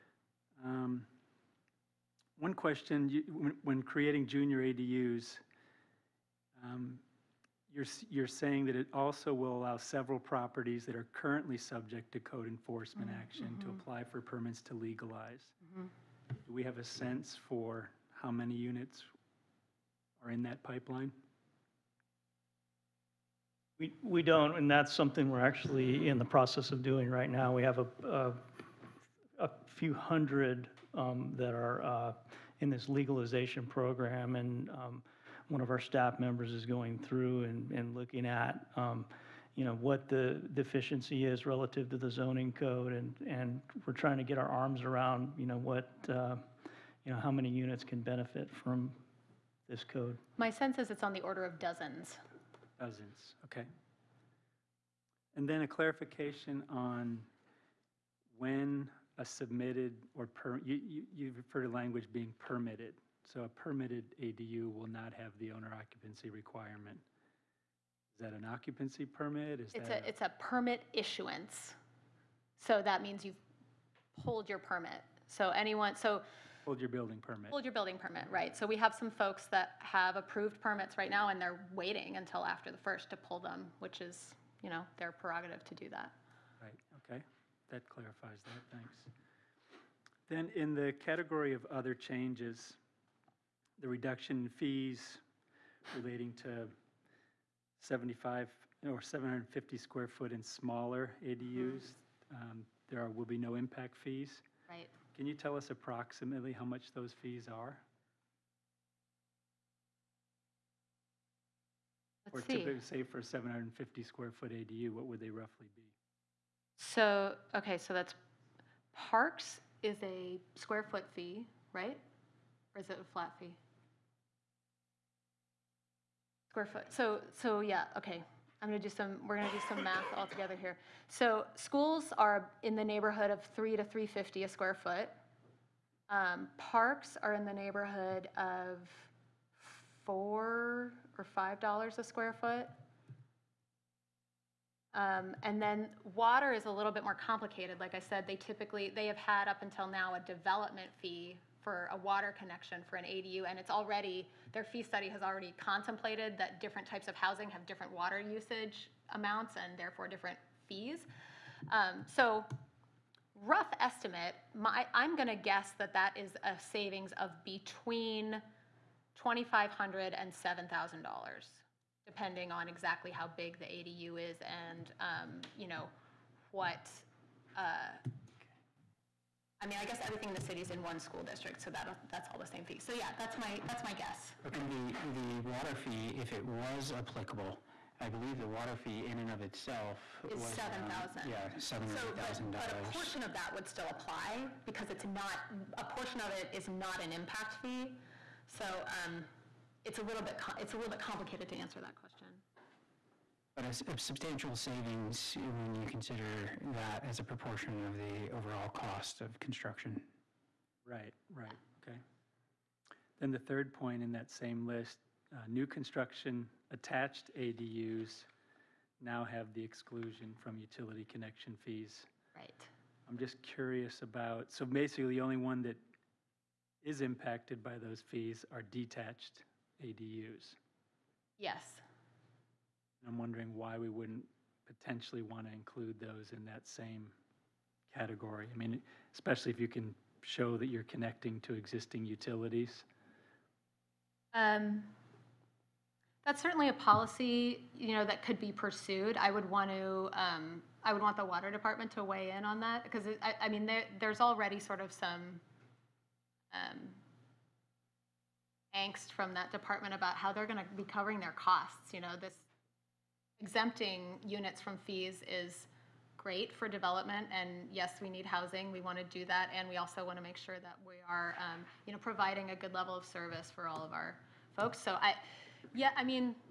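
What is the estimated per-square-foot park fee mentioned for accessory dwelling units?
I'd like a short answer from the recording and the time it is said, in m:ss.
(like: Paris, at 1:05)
$4 or $5, at 2:20.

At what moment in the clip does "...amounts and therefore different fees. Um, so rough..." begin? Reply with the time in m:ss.
2:39.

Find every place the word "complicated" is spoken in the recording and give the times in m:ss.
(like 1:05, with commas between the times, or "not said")
2:27, 3:20.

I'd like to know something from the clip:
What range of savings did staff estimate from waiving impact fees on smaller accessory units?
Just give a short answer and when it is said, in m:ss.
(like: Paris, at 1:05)
$2,500 to $7,000, at 2:47.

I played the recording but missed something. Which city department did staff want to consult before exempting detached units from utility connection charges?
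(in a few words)
Water department.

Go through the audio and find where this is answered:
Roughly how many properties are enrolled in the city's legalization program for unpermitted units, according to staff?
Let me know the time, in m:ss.
0:29.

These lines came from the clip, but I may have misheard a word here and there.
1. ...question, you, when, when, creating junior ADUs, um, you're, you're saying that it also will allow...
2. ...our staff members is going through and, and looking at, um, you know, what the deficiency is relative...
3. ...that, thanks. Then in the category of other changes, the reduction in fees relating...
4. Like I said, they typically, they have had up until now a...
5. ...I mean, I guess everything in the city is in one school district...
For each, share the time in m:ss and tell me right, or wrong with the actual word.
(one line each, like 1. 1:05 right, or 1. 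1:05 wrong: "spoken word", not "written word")
1. 0:02 right
2. 0:35 right
3. 1:28 right
4. 2:27 right
5. 2:59 right.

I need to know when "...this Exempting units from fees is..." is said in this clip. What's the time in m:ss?
4:22.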